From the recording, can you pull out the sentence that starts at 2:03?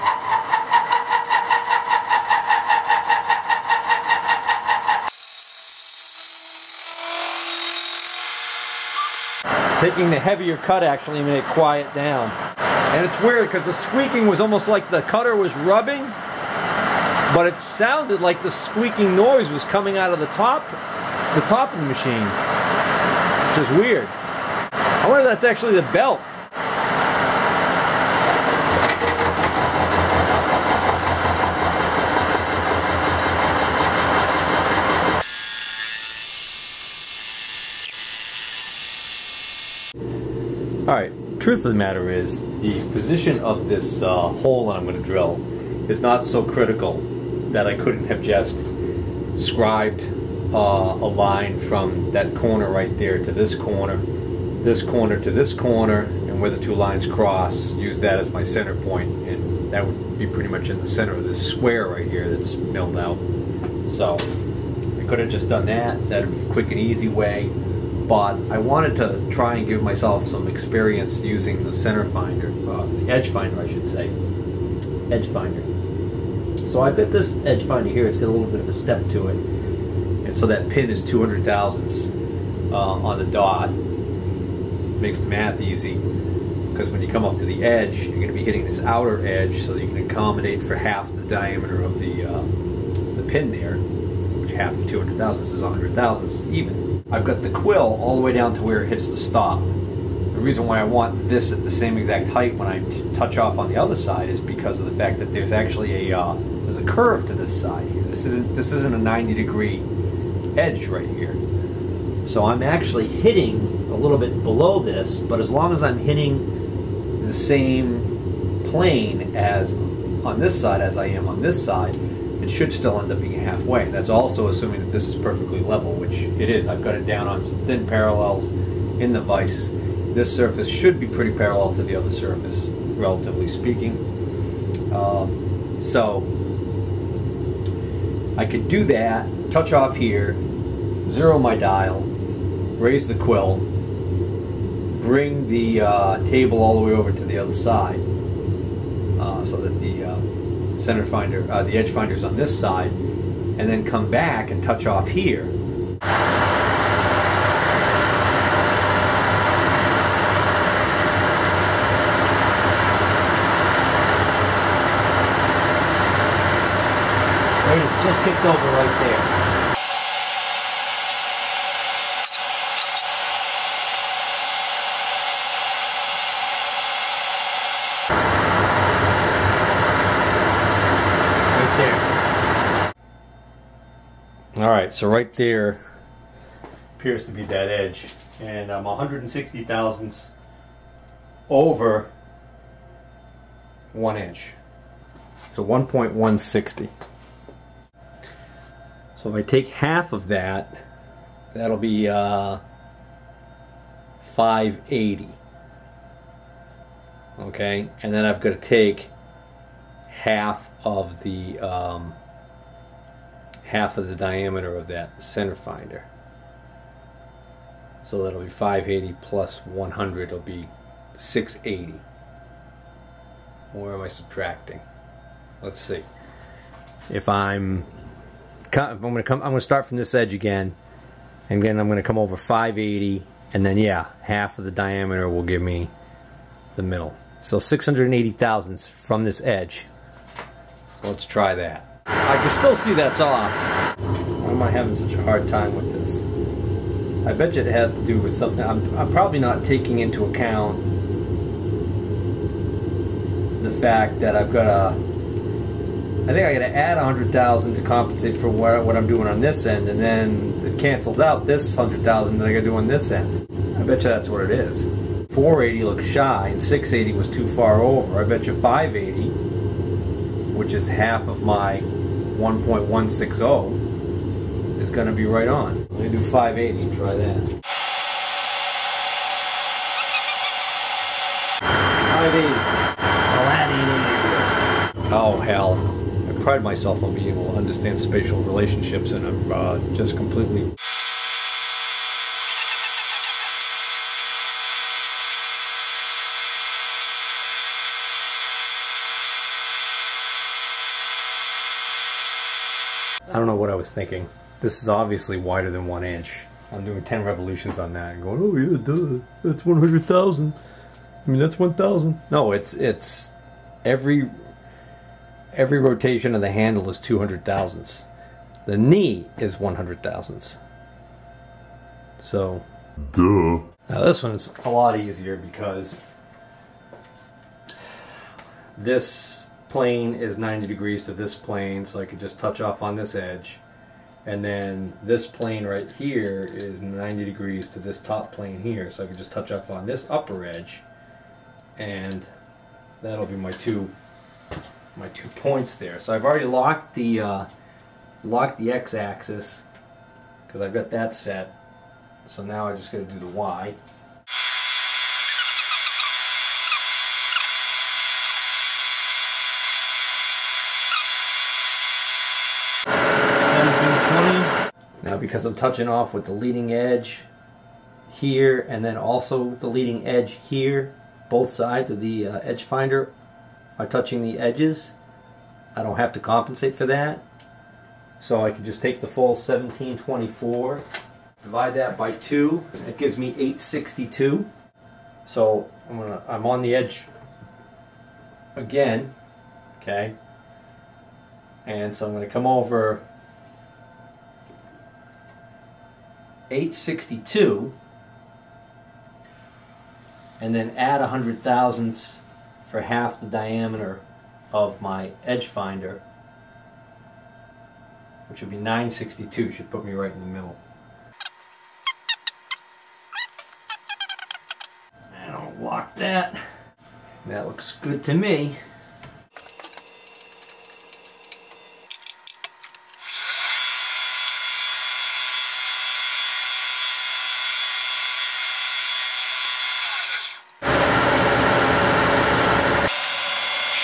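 That's also assuming that this is perfectly level, which it is.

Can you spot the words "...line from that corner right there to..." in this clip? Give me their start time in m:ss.
0:51.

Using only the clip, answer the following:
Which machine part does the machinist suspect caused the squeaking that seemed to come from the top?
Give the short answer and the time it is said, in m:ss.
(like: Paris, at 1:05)
The belt, at 0:25.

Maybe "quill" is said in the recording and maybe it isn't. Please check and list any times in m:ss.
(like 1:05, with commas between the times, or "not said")
1:37, 2:23.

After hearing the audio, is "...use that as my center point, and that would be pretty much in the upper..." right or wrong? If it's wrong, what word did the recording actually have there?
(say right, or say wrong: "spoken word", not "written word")
wrong: "center", not "upper".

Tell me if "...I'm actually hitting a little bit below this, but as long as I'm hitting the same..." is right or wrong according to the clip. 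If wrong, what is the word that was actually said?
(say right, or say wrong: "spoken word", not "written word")
right.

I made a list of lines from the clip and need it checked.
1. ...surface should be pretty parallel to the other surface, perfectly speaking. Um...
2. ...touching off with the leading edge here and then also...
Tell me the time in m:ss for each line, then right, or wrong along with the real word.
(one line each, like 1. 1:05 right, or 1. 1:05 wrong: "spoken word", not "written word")
1. 2:10 wrong: "relatively", not "perfectly"
2. 6:05 right.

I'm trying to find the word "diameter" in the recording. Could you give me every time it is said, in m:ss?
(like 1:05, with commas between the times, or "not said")
1:31, 3:34, 3:54, 6:43.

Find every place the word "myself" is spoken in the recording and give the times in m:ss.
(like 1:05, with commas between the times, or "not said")
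1:09, 4:46.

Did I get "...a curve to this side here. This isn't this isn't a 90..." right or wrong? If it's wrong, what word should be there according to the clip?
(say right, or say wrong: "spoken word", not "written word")
right.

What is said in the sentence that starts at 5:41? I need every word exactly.
And that'll be my two my two points there.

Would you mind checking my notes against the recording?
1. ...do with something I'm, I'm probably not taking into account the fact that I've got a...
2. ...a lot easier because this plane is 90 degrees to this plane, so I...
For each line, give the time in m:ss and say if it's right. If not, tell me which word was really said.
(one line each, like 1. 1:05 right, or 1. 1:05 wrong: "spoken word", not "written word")
1. 4:08 right
2. 5:24 right.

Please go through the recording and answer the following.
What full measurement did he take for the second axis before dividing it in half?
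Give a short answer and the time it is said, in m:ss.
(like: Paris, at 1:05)
1724, at 6:19.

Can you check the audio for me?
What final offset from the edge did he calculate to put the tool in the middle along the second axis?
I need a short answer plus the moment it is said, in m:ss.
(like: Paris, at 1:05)
962, at 6:48.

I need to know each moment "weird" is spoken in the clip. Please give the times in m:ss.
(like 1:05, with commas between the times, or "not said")
0:13, 0:23.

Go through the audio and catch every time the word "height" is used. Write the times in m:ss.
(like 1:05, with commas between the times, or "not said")
1:42.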